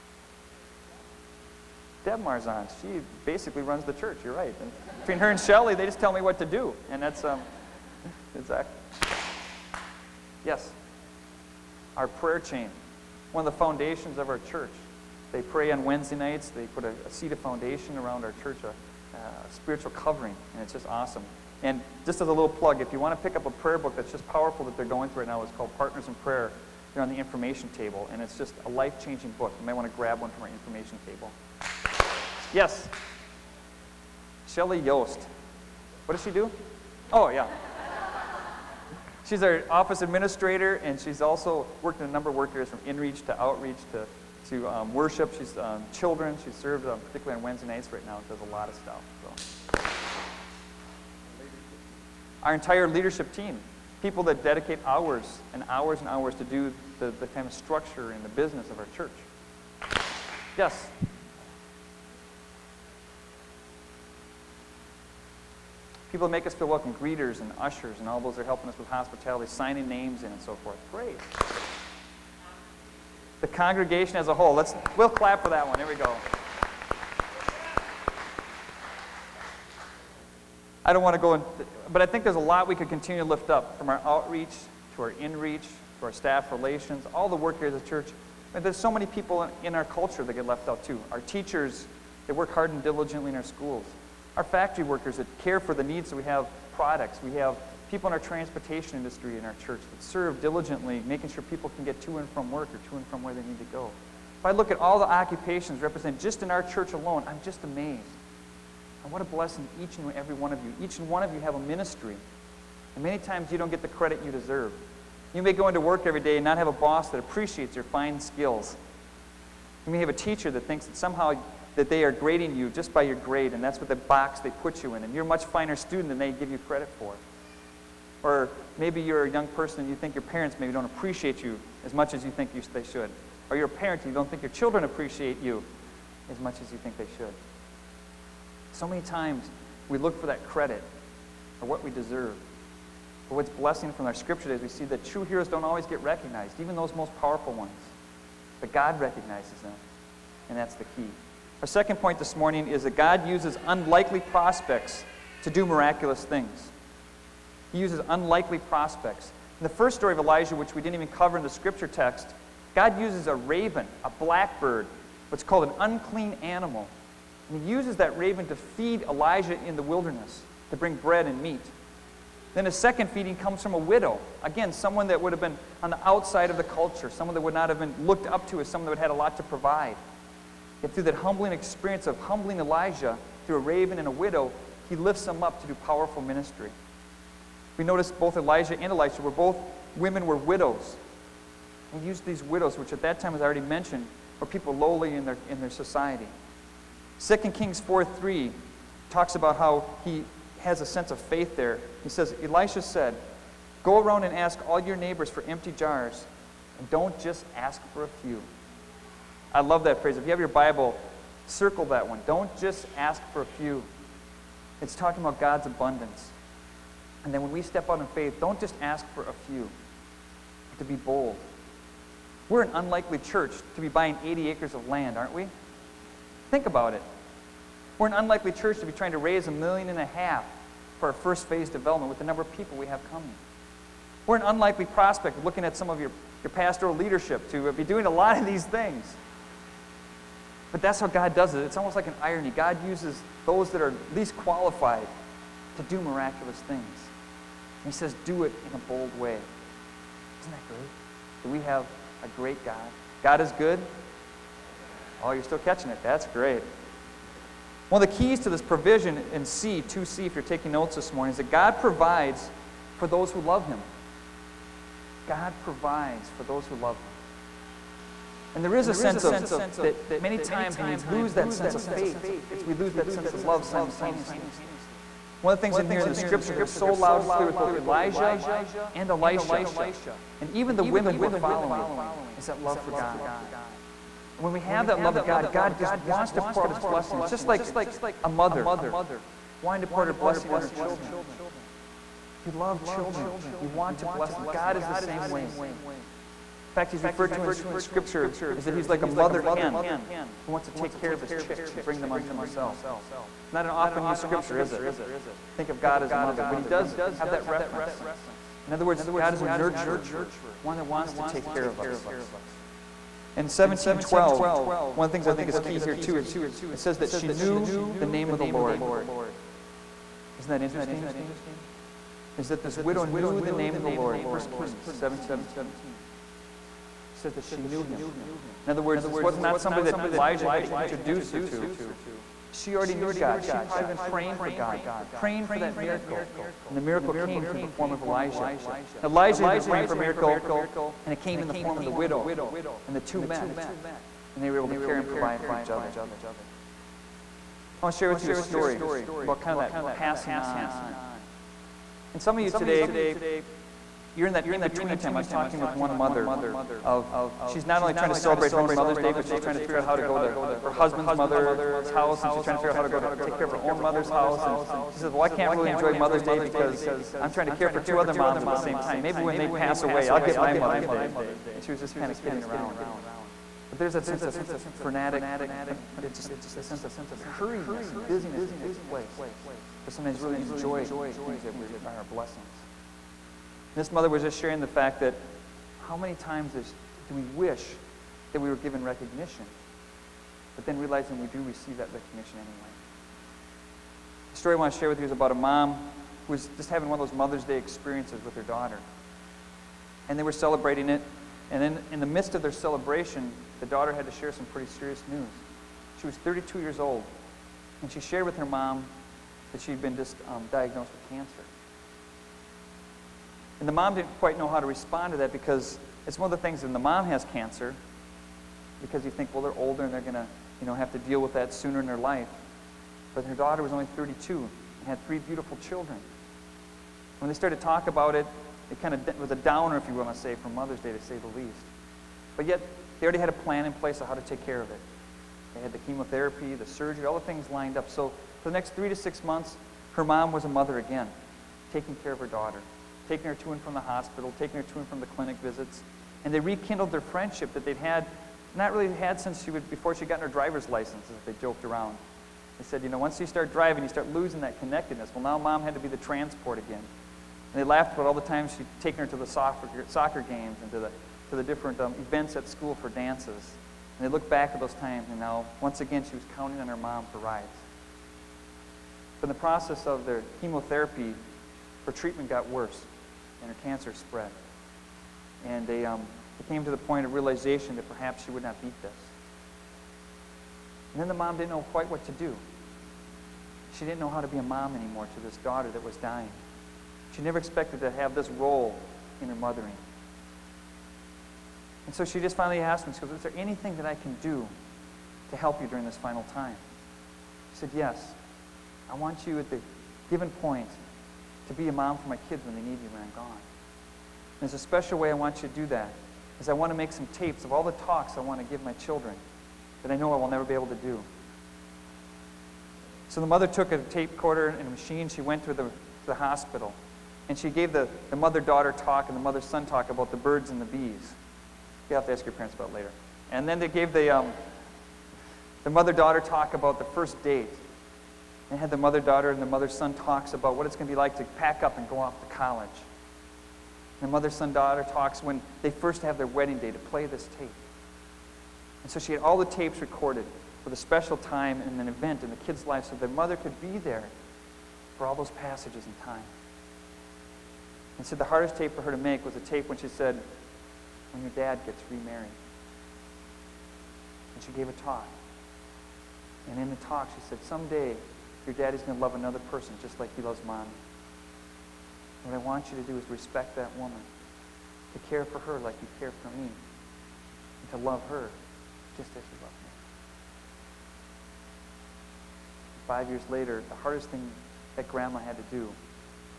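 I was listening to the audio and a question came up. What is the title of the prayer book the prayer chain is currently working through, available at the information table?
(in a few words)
Partners in Prayer.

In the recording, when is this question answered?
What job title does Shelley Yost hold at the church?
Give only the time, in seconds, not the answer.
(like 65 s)
39 s.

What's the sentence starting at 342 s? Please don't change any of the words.
And the two met, and they were able to care and provide for each other.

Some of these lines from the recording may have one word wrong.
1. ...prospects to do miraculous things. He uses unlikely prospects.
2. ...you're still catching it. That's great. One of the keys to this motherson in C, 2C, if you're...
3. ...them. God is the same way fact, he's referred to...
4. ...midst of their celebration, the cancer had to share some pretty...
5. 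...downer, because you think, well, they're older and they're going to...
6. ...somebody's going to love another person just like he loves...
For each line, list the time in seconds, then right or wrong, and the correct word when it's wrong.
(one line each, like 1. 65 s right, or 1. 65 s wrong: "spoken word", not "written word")
1. 154 s right
2. 255 s wrong: "provision", not "motherson"
3. 294 s right
4. 402 s wrong: "daughter", not "cancer"
5. 417 s wrong: "cancer", not "downer"
6. 558 s wrong: "daddy", not "somebody".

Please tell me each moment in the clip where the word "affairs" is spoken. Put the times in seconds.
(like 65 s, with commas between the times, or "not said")
not said.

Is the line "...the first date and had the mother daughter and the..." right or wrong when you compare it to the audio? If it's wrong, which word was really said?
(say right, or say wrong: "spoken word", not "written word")
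right.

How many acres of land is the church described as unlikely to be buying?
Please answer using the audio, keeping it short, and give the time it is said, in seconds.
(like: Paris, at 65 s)
80, at 224 s.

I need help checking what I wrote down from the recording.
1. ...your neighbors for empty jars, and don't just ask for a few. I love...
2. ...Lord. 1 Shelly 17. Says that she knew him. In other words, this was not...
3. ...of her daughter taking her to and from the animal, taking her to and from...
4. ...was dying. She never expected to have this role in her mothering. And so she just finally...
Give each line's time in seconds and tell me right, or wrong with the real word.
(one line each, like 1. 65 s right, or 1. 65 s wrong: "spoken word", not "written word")
1. 204 s right
2. 323 s wrong: "Kings", not "Shelly"
3. 442 s wrong: "hospital", not "animal"
4. 485 s right.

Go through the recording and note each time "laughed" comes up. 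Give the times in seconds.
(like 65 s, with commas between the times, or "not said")
457 s.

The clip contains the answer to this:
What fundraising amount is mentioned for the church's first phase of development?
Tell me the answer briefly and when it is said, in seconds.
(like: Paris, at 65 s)
1.5 million, at 229 s.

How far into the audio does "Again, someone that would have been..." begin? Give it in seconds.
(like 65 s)
174 s.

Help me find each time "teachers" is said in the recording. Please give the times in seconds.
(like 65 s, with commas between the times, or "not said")
91 s, 120 s.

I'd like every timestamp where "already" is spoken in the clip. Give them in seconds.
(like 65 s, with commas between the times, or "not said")
193 s, 332 s, 433 s.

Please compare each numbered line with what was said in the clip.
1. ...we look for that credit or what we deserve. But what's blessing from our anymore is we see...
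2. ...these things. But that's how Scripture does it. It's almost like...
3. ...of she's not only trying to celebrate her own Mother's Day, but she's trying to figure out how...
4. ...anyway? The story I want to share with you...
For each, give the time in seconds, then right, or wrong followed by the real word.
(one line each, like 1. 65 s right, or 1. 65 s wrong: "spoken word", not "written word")
1. 139 s wrong: "scripture", not "anymore"
2. 238 s wrong: "God", not "Scripture"
3. 356 s right
4. 392 s right.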